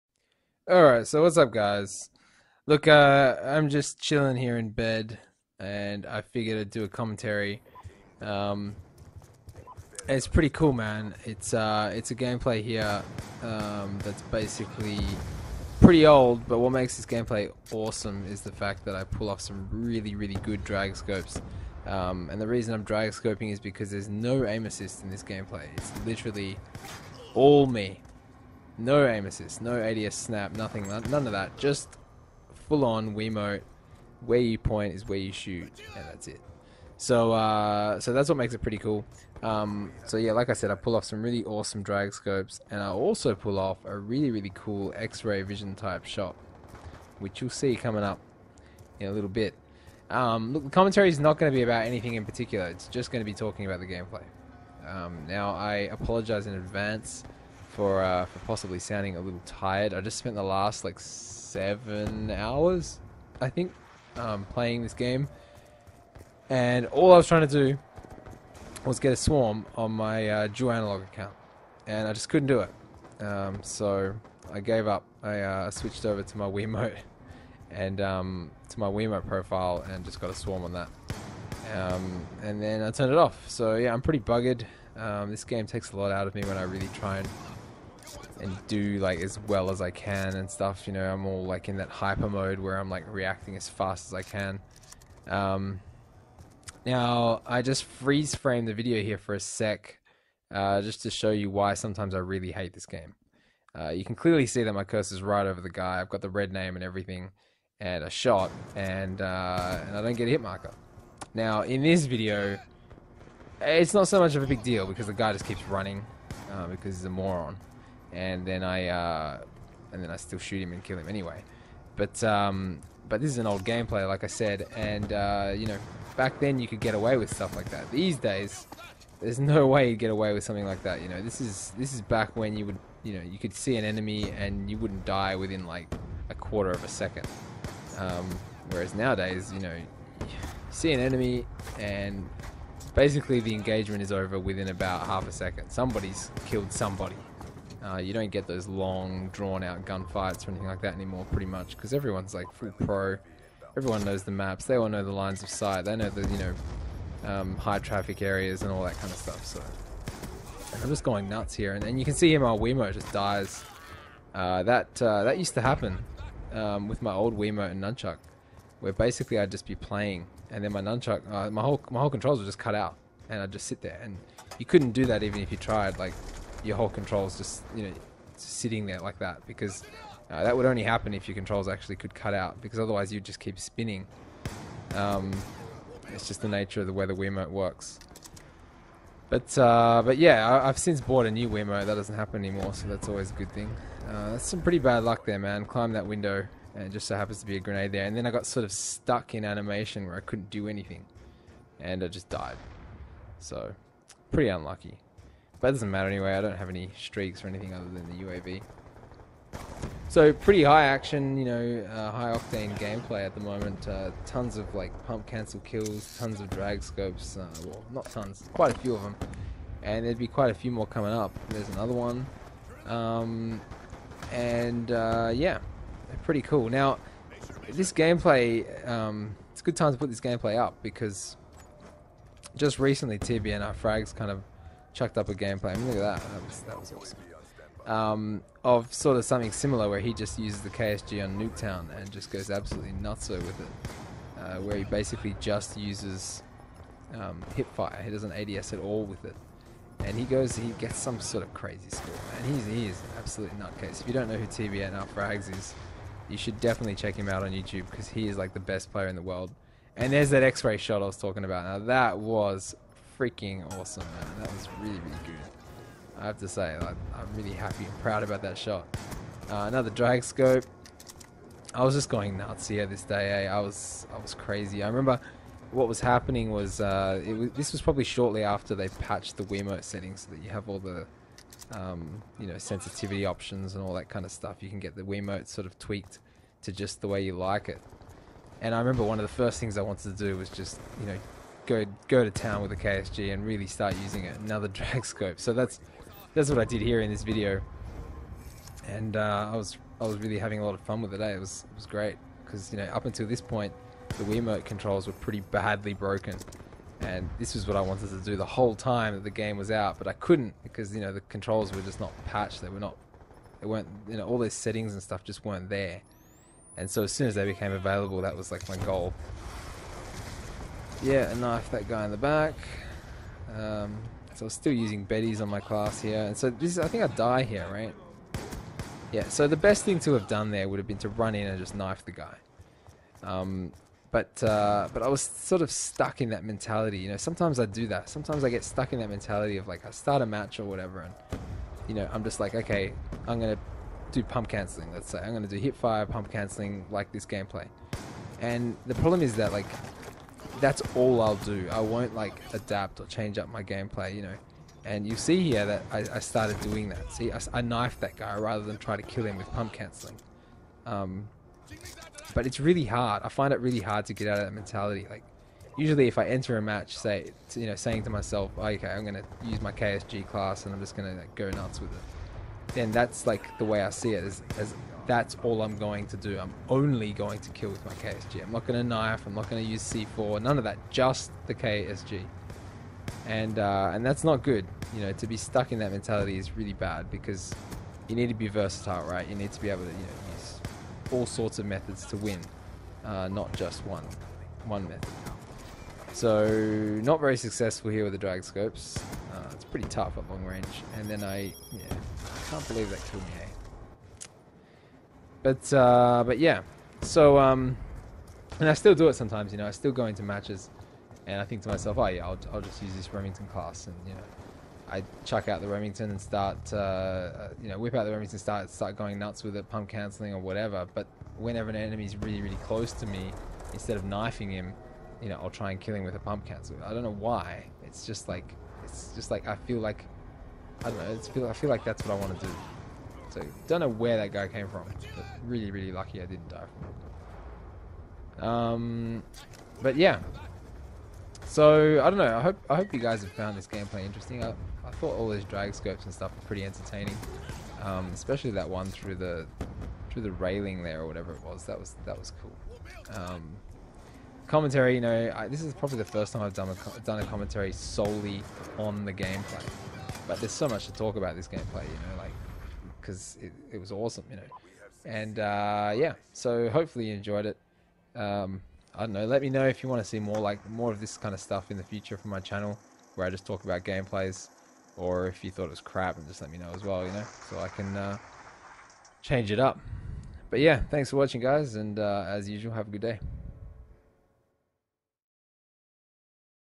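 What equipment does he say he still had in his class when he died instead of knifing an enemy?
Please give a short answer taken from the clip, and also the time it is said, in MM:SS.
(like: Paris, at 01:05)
Betty's, at 05:25.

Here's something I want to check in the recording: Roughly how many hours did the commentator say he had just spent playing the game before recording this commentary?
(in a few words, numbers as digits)
7.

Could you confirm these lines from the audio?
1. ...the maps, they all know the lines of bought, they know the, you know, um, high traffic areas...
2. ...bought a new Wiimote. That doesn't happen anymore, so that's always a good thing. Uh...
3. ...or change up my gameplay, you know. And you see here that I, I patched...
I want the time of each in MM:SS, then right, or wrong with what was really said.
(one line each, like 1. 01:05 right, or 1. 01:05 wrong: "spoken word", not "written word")
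1. 02:34 wrong: "sight", not "bought"
2. 03:11 right
3. 05:52 wrong: "started", not "patched".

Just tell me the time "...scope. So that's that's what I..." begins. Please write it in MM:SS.
04:55.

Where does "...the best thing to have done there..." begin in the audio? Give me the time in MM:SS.
05:29.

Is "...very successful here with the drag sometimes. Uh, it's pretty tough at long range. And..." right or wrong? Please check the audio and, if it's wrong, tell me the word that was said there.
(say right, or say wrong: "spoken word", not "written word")
wrong: "scopes", not "sometimes".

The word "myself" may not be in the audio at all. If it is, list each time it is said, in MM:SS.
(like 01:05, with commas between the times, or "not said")
06:08, 06:51.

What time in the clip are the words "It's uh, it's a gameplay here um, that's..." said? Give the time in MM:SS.
00:11.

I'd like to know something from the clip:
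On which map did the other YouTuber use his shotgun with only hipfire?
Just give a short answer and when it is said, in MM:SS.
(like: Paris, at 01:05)
Nuketown, at 04:01.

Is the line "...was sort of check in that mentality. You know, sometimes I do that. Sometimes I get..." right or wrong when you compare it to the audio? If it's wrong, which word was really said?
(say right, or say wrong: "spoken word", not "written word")
wrong: "stuck", not "check".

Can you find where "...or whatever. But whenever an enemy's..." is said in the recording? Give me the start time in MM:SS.
07:00.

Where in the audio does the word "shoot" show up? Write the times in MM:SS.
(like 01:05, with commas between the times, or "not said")
00:35, 02:00.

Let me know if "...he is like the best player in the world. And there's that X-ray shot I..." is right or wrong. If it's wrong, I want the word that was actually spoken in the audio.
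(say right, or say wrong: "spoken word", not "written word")
right.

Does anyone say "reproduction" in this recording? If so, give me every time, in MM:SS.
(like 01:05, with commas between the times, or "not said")
not said.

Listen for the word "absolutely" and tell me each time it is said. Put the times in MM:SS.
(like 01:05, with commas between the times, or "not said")
04:02, 04:13.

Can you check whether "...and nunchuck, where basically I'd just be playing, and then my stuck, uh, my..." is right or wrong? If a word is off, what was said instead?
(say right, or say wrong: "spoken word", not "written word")
wrong: "nunchuck", not "stuck".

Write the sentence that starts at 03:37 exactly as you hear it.
Uh, well, not tons, quite a few of them.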